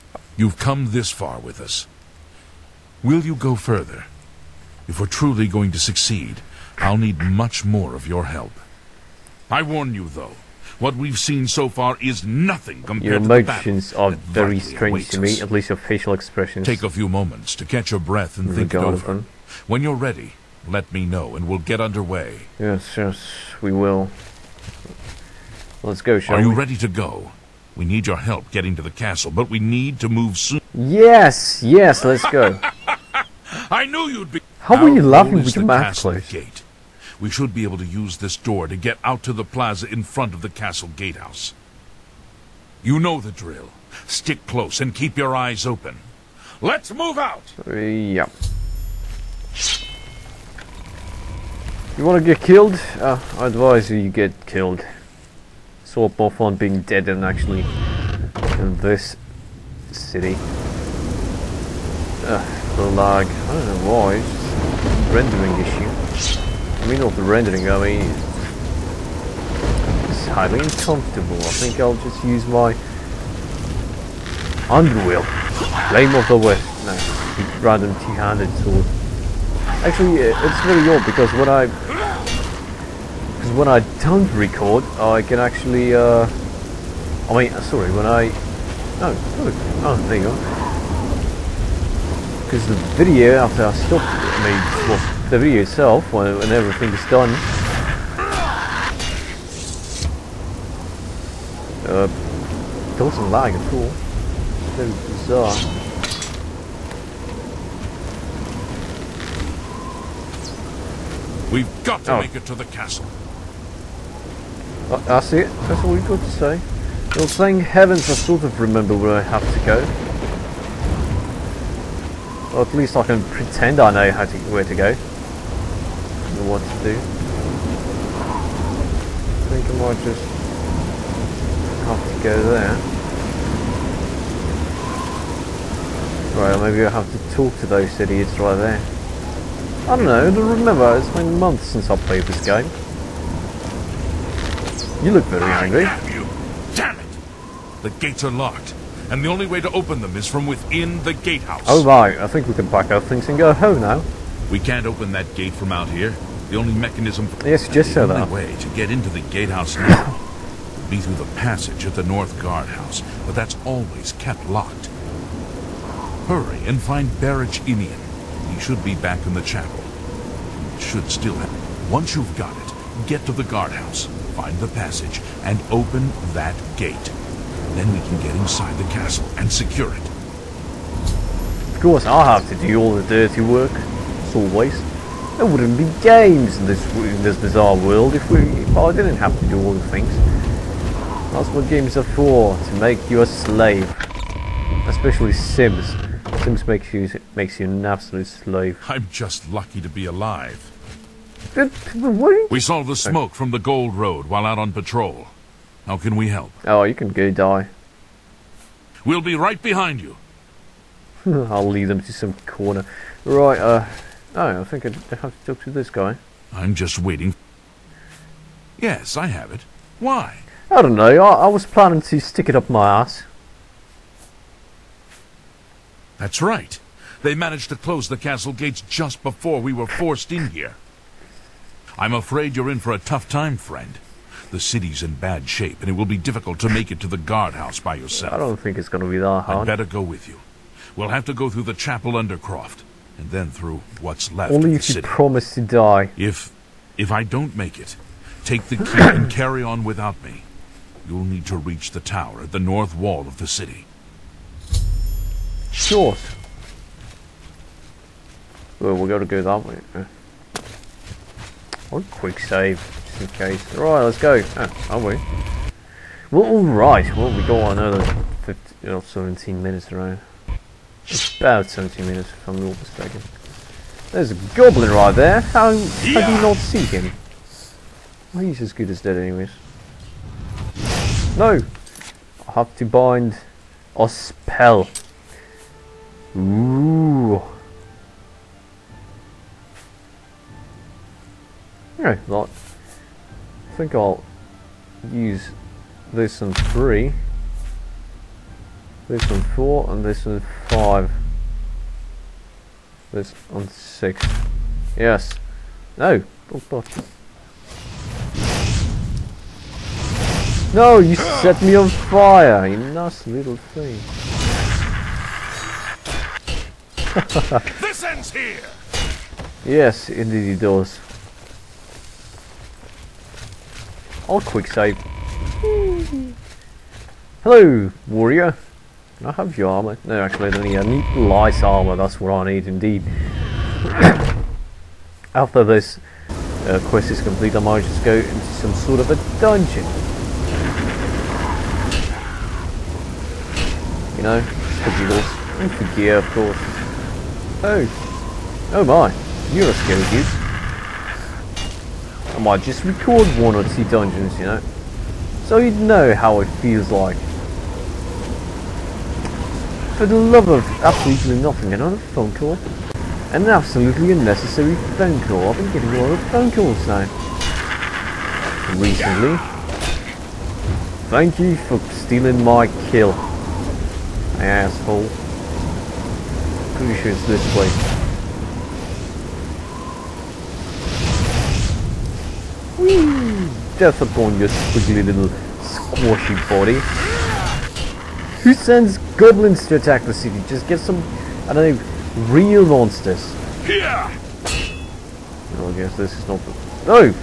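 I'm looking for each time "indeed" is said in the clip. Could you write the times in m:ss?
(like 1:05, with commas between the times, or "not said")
5:20, 5:32.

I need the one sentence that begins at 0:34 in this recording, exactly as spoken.
How will you love me with the castle Gate.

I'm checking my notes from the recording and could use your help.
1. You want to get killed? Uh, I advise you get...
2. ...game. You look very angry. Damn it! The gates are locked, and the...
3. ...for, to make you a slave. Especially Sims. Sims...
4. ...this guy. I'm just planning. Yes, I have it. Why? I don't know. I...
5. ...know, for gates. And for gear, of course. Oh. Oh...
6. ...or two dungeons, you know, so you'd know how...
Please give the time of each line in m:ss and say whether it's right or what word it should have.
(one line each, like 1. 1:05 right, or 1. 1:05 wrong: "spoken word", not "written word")
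1. 0:51 right
2. 2:22 right
3. 3:12 right
4. 3:35 wrong: "waiting", not "planning"
5. 5:44 wrong: "giggles", not "gates"
6. 5:53 right.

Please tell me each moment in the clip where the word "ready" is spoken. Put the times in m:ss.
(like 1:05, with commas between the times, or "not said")
0:20, 0:26.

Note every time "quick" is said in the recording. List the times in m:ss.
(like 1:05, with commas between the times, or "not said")
4:22, 5:24.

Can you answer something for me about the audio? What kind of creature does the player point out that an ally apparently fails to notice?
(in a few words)
A goblin.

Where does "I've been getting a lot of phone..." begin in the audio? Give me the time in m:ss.
6:05.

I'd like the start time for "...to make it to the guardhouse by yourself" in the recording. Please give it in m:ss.
3:56.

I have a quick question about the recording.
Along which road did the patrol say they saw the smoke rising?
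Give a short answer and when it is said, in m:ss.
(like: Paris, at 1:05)
Gold Road, at 3:23.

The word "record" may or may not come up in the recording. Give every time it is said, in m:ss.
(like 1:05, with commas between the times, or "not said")
1:24, 5:52.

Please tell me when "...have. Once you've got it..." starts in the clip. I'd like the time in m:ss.
2:51.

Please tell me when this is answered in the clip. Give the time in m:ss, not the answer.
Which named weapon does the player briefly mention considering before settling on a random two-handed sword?
1:15.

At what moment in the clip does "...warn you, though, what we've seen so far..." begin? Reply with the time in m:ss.
0:09.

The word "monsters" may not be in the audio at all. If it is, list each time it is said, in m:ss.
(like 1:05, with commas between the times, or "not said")
6:32.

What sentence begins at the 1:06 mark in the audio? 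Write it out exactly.
I mean not the rendering, I mean it's highly uncomfortable.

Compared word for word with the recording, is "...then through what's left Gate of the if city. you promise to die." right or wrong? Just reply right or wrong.
wrong.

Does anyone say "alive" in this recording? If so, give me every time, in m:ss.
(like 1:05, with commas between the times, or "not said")
3:20.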